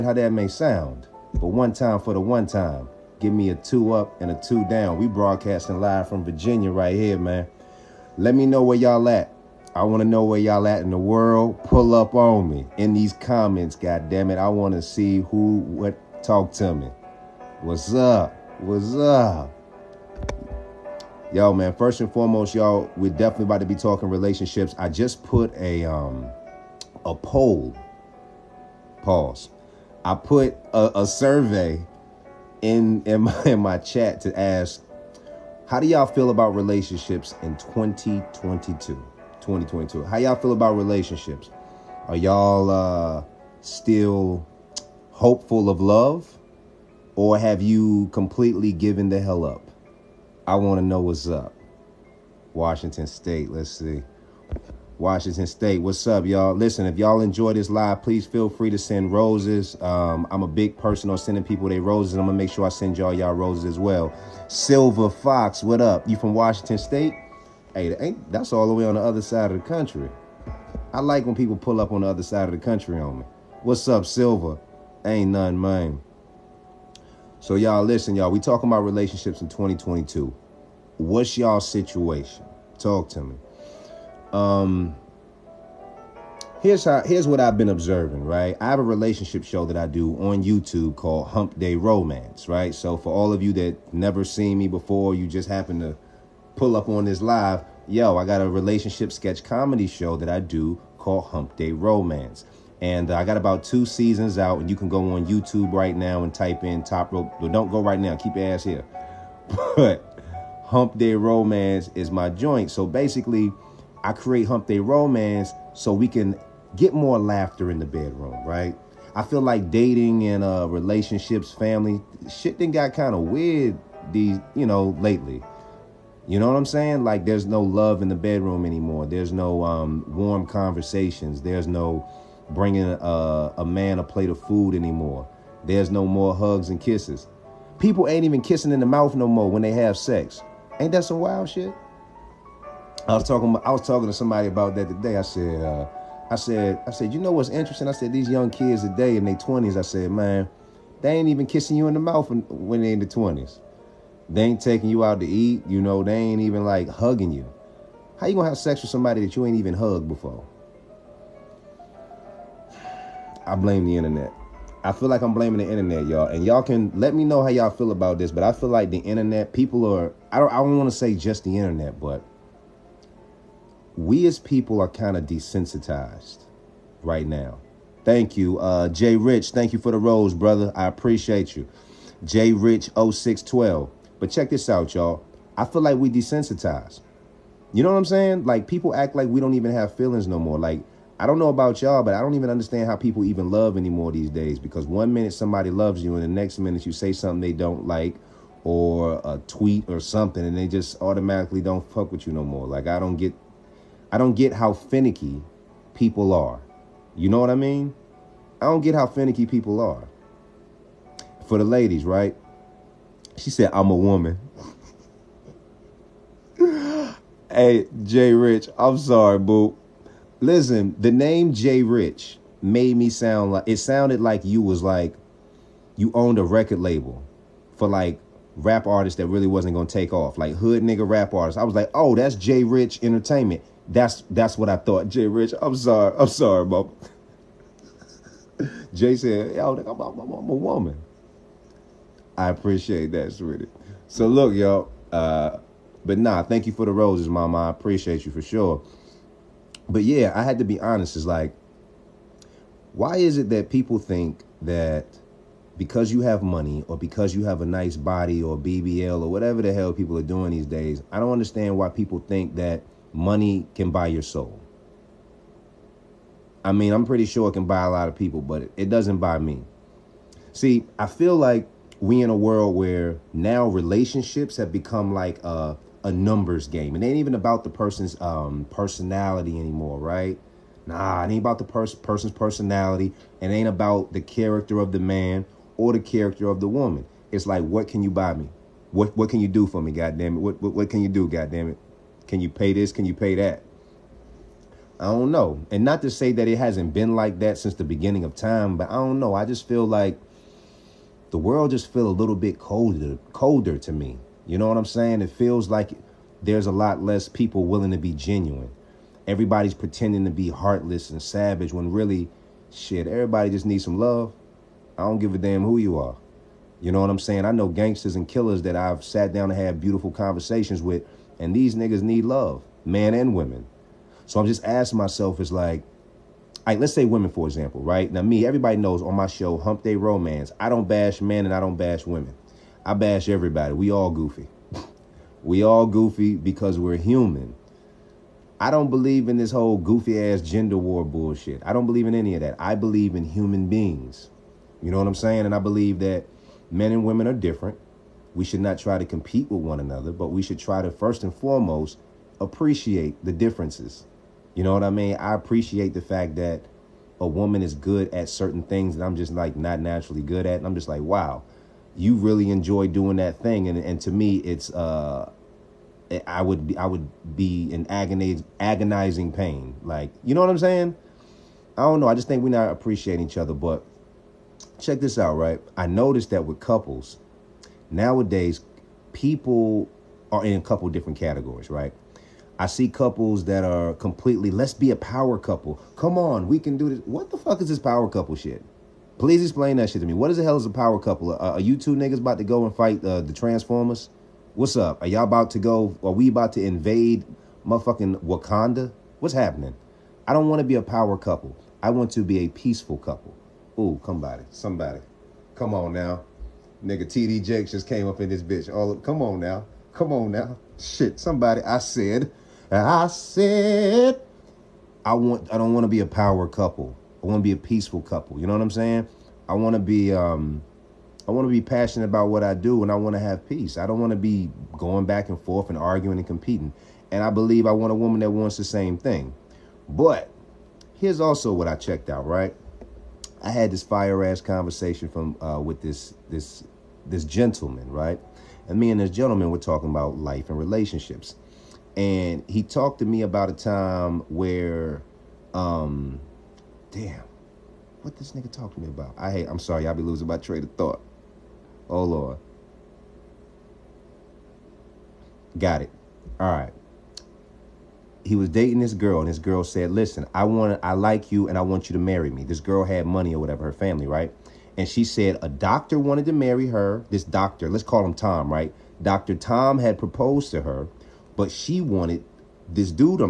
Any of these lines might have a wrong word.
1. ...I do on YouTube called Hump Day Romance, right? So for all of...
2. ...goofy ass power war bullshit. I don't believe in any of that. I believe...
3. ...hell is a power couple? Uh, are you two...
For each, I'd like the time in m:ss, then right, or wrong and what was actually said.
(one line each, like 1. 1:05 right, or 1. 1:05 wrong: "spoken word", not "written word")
1. 1:29 right
2. 5:39 wrong: "gender", not "power"
3. 6:30 right.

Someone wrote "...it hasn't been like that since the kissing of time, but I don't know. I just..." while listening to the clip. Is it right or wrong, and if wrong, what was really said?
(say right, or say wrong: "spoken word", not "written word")
wrong: "beginning", not "kissing".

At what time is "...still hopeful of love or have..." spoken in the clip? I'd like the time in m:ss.
0:43.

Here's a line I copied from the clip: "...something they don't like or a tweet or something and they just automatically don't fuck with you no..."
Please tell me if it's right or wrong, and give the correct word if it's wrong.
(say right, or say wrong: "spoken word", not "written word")
right.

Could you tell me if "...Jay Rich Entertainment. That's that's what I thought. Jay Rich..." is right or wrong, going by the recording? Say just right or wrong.
right.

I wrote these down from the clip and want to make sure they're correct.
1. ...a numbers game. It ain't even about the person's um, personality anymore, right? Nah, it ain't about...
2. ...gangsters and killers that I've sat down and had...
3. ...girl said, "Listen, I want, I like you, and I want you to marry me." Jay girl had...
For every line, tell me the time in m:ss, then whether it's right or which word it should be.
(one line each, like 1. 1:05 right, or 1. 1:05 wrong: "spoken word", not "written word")
1. 4:36 right
2. 5:17 right
3. 7:39 wrong: "This", not "Jay".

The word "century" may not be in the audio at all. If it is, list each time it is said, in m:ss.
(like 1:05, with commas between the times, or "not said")
not said.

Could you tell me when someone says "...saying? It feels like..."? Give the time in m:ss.
5:04.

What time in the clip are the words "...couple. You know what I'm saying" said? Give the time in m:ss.
6:58.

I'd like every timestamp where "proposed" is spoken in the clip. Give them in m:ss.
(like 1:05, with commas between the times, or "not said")
7:49.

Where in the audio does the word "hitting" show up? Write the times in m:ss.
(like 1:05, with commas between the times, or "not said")
not said.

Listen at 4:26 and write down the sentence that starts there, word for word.
I mean, I'm pretty sure it can buy a lot of people, but it doesn't buy me.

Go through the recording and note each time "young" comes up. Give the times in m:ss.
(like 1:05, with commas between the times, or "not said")
2:28.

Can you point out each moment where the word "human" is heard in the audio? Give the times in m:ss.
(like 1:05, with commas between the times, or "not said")
5:36, 5:43.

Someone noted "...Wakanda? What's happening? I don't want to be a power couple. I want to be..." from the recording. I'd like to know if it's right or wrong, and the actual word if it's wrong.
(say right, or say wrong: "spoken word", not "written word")
right.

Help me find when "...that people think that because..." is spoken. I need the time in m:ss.
4:13.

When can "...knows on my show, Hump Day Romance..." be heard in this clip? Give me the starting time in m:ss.
5:28.